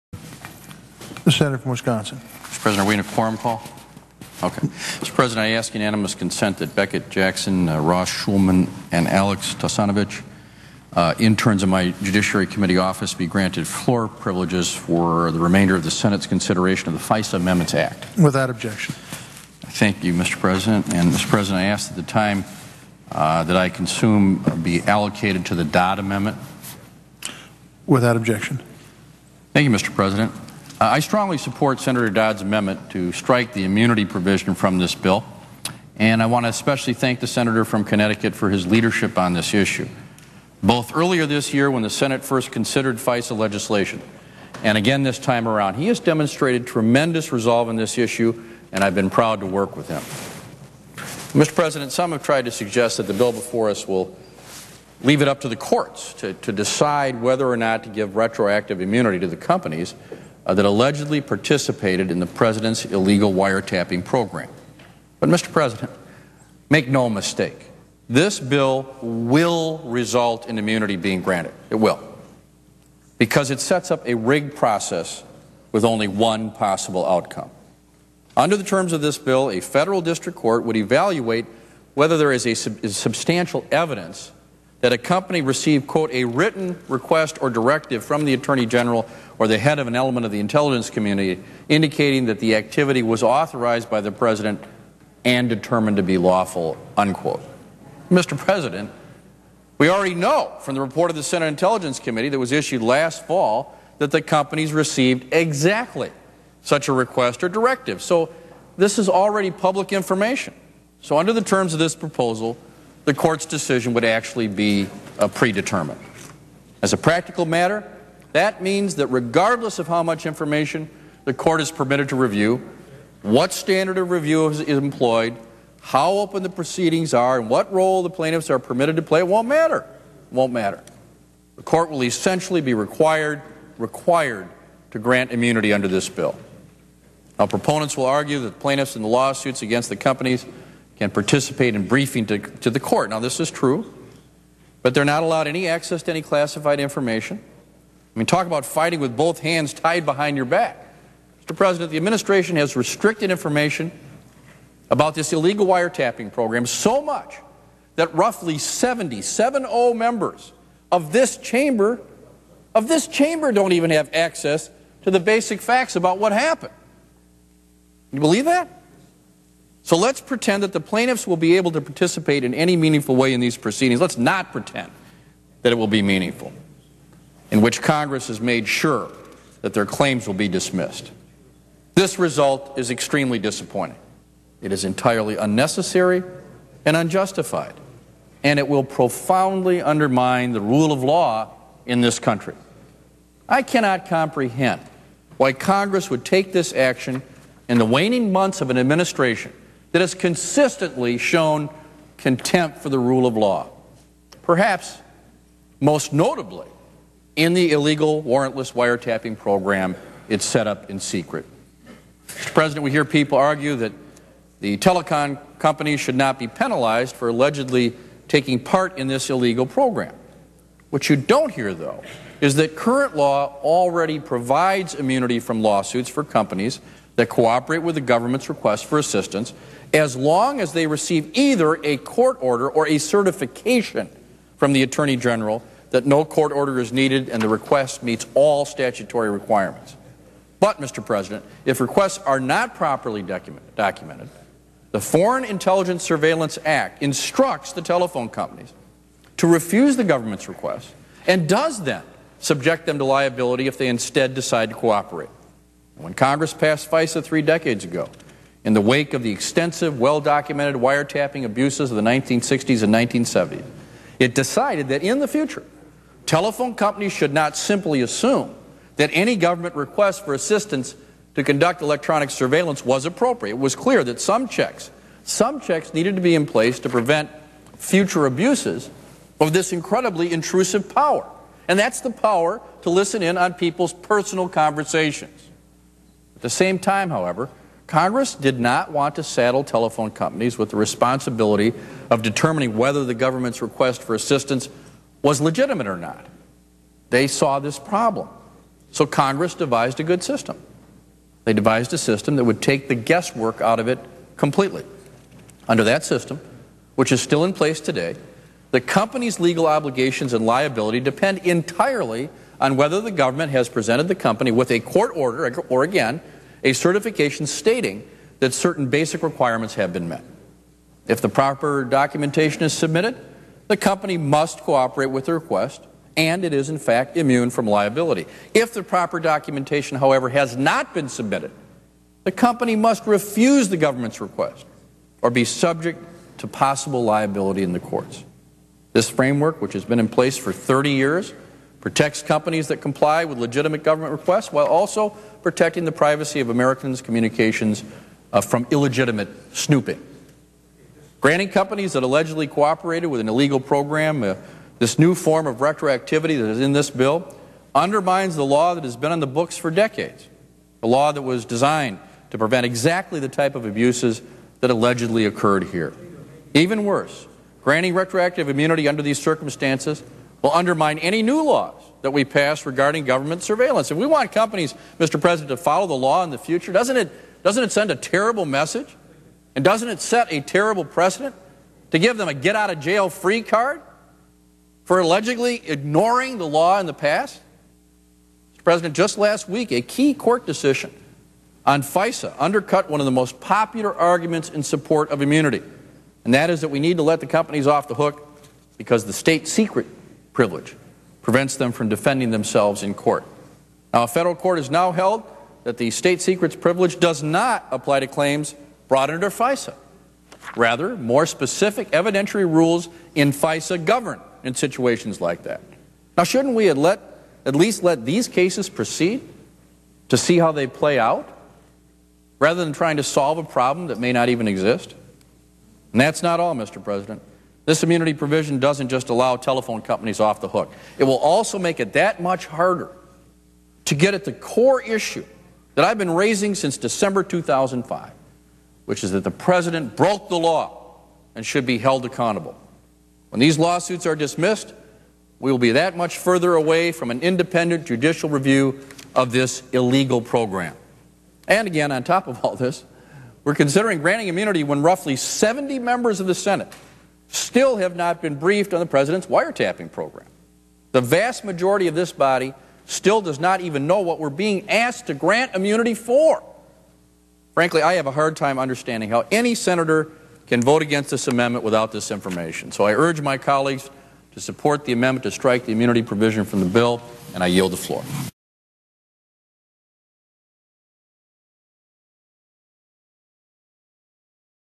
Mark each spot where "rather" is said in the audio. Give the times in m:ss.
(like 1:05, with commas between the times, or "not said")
6:50, 7:02.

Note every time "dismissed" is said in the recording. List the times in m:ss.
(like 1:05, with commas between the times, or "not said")
3:00, 7:24.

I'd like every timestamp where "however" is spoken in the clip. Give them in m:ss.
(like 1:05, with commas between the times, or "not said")
4:47, 5:29.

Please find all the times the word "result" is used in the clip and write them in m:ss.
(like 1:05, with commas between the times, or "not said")
1:09, 3:02.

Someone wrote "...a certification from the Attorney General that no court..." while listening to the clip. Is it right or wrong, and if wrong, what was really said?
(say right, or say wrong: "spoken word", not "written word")
right.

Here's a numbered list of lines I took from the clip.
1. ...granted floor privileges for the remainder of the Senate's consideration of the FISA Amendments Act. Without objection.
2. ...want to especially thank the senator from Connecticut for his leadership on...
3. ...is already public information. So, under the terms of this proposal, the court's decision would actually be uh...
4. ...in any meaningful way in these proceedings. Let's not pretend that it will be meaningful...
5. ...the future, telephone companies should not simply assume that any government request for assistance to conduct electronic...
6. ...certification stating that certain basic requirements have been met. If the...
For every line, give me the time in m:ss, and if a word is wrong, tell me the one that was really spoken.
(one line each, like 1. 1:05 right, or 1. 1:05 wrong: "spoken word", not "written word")
1. 0:13 right
2. 0:36 right
3. 1:48 right
4. 2:52 right
5. 4:25 right
6. 5:16 right.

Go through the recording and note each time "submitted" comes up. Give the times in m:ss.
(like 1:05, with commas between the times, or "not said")
5:22, 5:31.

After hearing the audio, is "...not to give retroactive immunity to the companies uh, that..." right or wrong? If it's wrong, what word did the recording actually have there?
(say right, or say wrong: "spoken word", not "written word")
right.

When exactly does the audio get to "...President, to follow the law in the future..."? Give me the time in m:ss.
6:15.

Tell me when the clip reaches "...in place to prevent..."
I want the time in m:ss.
4:36.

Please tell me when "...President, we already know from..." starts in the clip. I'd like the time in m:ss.
1:38.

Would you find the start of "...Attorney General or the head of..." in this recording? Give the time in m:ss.
1:28.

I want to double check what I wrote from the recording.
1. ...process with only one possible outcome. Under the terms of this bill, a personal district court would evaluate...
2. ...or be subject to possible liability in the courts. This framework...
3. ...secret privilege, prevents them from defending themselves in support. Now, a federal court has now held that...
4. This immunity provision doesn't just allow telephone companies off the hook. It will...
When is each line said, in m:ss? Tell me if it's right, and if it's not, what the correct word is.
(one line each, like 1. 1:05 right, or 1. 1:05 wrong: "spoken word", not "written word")
1. 1:14 wrong: "federal", not "personal"
2. 5:35 right
3. 6:39 wrong: "court", not "support"
4. 7:07 right.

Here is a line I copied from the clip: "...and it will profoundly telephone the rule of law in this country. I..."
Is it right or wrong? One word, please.
wrong.